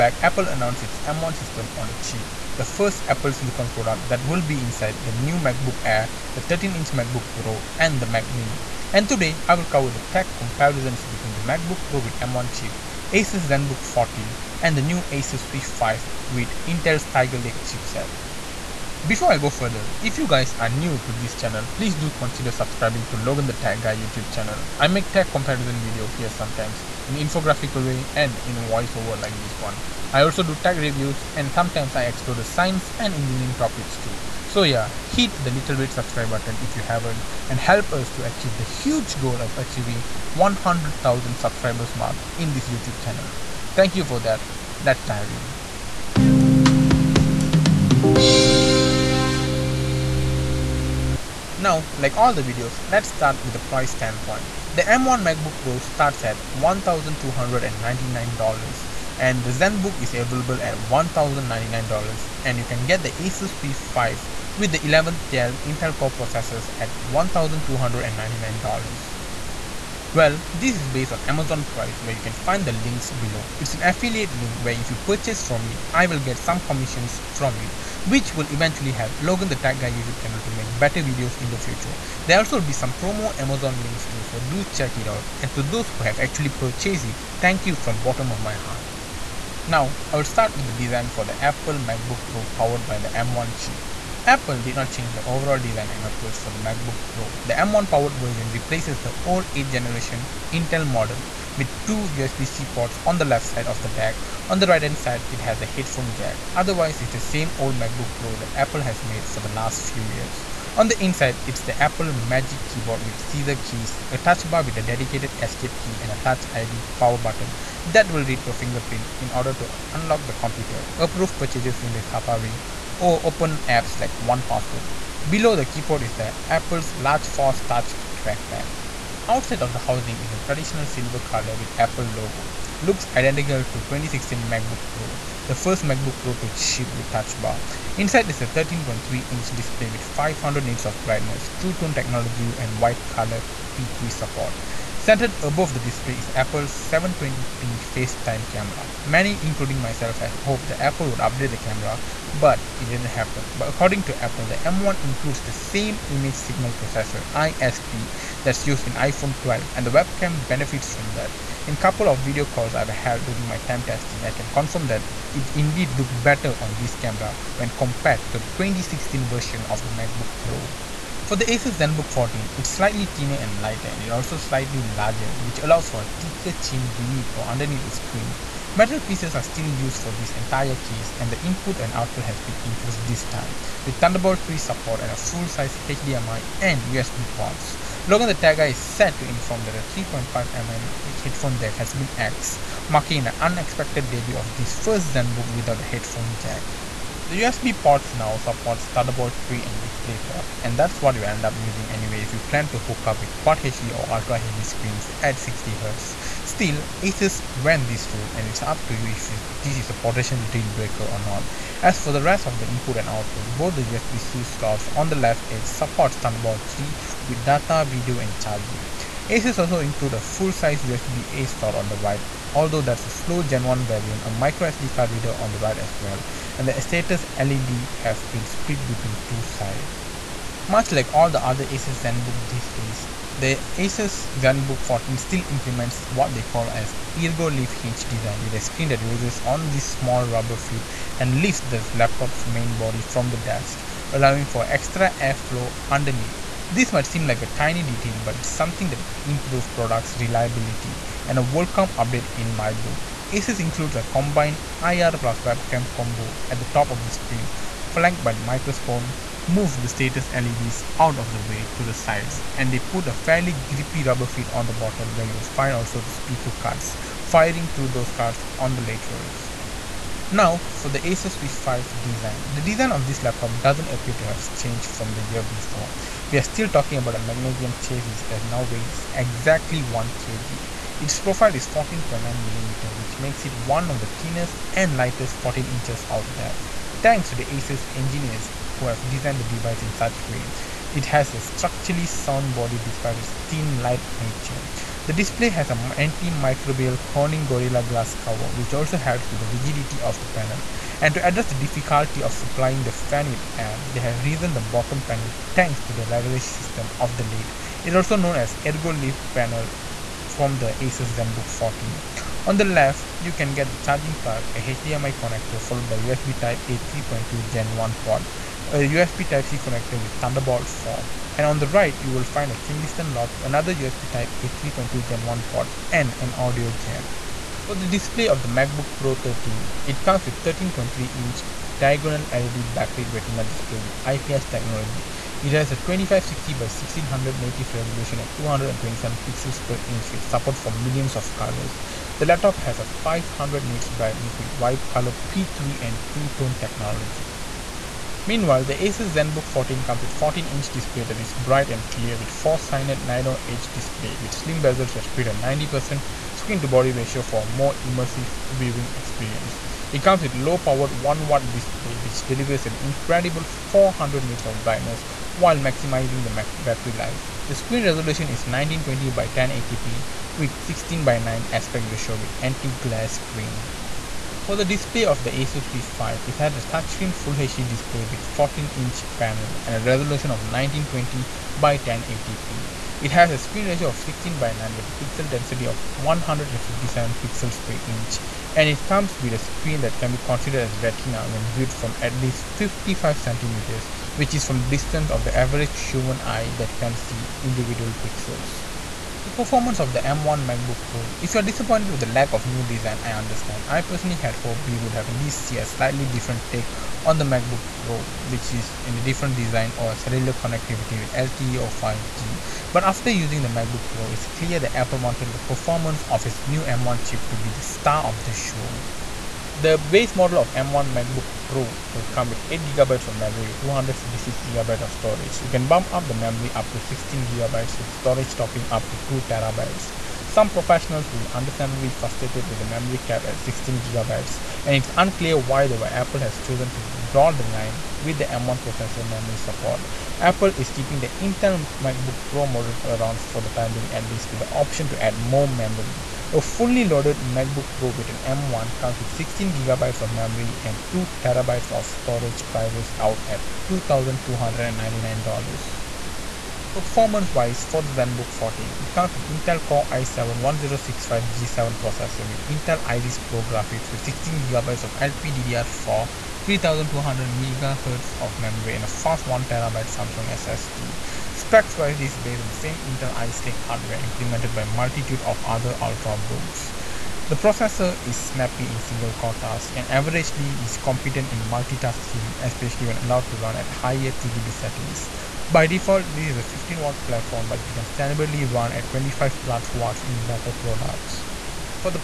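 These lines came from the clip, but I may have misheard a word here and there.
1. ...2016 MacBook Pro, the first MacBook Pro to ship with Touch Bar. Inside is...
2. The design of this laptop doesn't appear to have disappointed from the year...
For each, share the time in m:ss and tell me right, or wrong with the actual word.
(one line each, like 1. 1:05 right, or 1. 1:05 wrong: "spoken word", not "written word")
1. 2:13 right
2. 4:32 wrong: "changed", not "disappointed".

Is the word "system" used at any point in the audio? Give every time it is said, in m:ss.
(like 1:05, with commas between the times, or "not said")
0:01, 5:06.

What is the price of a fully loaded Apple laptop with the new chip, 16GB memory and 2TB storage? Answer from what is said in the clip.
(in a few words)
$2,299.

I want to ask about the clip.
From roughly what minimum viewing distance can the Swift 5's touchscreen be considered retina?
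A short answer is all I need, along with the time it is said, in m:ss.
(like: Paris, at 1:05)
55 centimeters, at 6:32.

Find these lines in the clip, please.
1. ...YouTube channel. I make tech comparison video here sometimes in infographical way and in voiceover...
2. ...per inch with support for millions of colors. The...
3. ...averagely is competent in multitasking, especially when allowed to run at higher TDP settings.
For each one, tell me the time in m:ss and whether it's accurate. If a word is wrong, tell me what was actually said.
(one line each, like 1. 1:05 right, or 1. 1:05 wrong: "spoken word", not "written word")
1. 0:23 right
2. 5:39 right
3. 7:59 right.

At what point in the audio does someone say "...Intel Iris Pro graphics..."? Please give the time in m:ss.
7:42.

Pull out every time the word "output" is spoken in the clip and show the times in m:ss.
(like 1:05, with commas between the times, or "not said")
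3:01, 3:33.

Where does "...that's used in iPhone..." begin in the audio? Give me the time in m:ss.
2:38.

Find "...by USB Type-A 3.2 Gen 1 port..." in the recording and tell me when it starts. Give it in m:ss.
5:15.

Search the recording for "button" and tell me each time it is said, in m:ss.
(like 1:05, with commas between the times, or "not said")
0:36, 1:57.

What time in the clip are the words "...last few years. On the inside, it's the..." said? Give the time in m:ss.
1:49.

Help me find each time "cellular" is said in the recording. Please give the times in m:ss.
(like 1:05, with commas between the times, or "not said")
6:49.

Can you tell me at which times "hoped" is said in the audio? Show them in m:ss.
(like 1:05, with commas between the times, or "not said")
2:30, 6:44.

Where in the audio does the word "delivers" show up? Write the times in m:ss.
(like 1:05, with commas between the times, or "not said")
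6:02.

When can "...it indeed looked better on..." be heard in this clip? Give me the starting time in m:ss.
2:45.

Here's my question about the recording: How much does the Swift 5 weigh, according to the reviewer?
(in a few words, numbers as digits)
1 kg.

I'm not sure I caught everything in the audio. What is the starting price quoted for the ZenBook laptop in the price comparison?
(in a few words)
$1,099.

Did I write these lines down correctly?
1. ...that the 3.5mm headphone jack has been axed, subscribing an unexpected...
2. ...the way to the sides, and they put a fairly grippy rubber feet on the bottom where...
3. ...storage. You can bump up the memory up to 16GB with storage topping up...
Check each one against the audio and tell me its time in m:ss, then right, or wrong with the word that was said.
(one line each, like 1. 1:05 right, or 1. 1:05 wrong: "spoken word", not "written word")
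1. 3:09 wrong: "marking", not "subscribing"
2. 4:21 right
3. 7:04 right.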